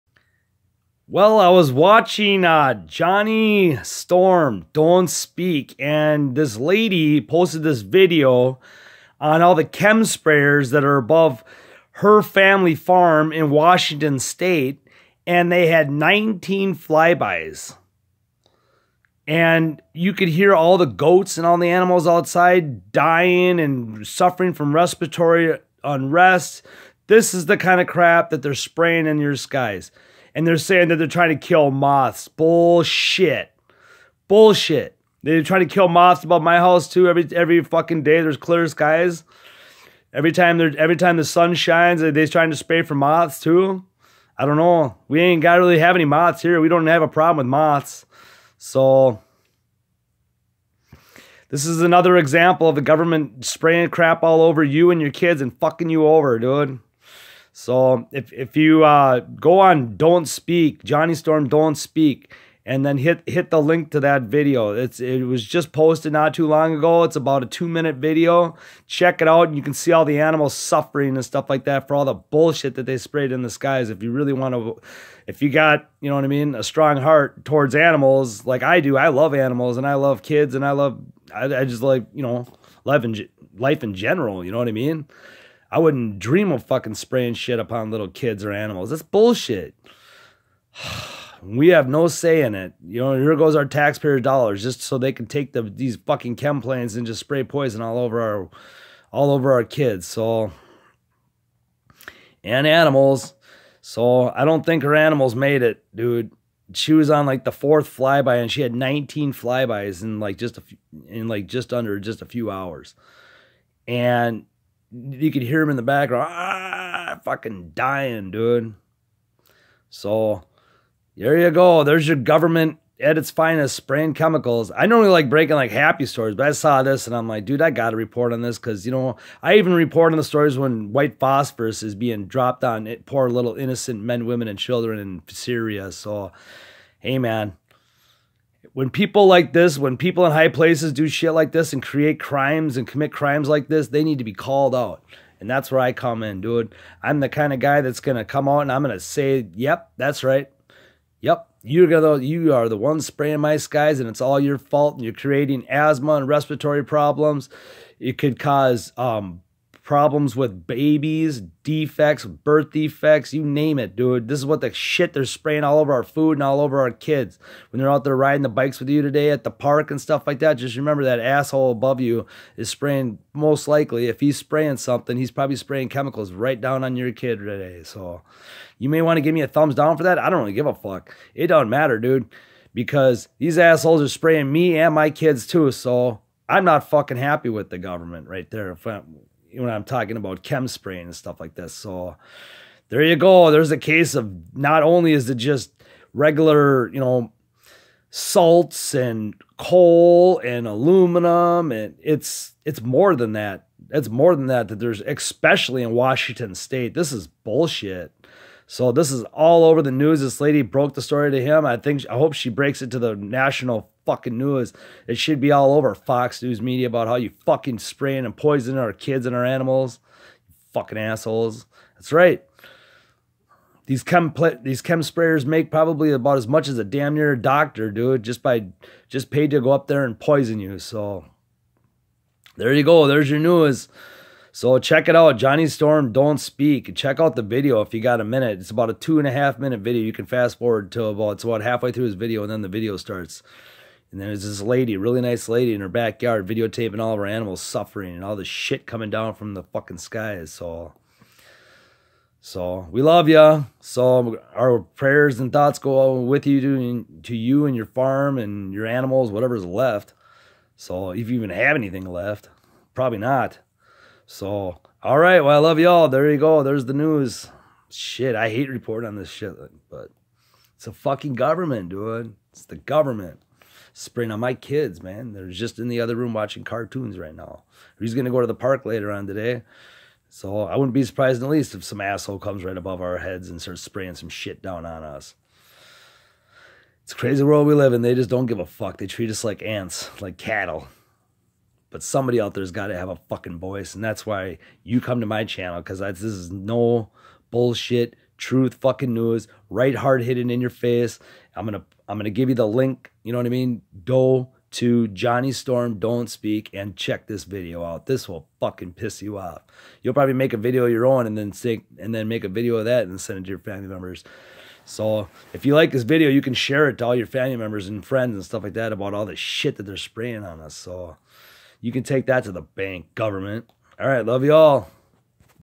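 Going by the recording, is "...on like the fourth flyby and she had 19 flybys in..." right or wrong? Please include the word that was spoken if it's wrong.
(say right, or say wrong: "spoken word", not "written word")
right.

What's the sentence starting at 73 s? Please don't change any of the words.
If you really want to, if you got you know what I mean, a strong heart towards animals like I do.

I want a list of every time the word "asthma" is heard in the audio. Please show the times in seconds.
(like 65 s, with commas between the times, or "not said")
155 s.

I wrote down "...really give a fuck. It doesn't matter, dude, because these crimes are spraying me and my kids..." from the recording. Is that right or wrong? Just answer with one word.
wrong.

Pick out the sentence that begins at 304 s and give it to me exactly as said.
Go to Johnny Storm Don't Speak and check this video out.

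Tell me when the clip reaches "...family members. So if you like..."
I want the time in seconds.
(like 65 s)
313 s.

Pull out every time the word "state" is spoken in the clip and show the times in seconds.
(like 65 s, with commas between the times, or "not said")
14 s, 206 s.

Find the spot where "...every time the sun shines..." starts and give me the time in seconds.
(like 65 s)
40 s.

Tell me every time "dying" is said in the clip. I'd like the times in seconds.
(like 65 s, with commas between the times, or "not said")
22 s, 117 s.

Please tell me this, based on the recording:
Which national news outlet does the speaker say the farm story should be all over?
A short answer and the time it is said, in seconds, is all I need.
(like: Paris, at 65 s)
Fox News, at 215 s.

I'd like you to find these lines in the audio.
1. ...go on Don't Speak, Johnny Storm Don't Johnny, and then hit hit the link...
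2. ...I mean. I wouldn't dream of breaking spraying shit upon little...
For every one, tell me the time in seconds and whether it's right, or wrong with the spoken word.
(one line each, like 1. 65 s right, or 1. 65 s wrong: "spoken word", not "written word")
1. 59 s wrong: "Speak", not "Johnny"
2. 84 s wrong: "fucking", not "breaking".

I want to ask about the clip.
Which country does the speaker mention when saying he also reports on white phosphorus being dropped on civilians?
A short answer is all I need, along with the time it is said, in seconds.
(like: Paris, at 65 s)
Syria, at 135 s.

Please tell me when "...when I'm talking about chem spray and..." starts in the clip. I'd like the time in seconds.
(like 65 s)
189 s.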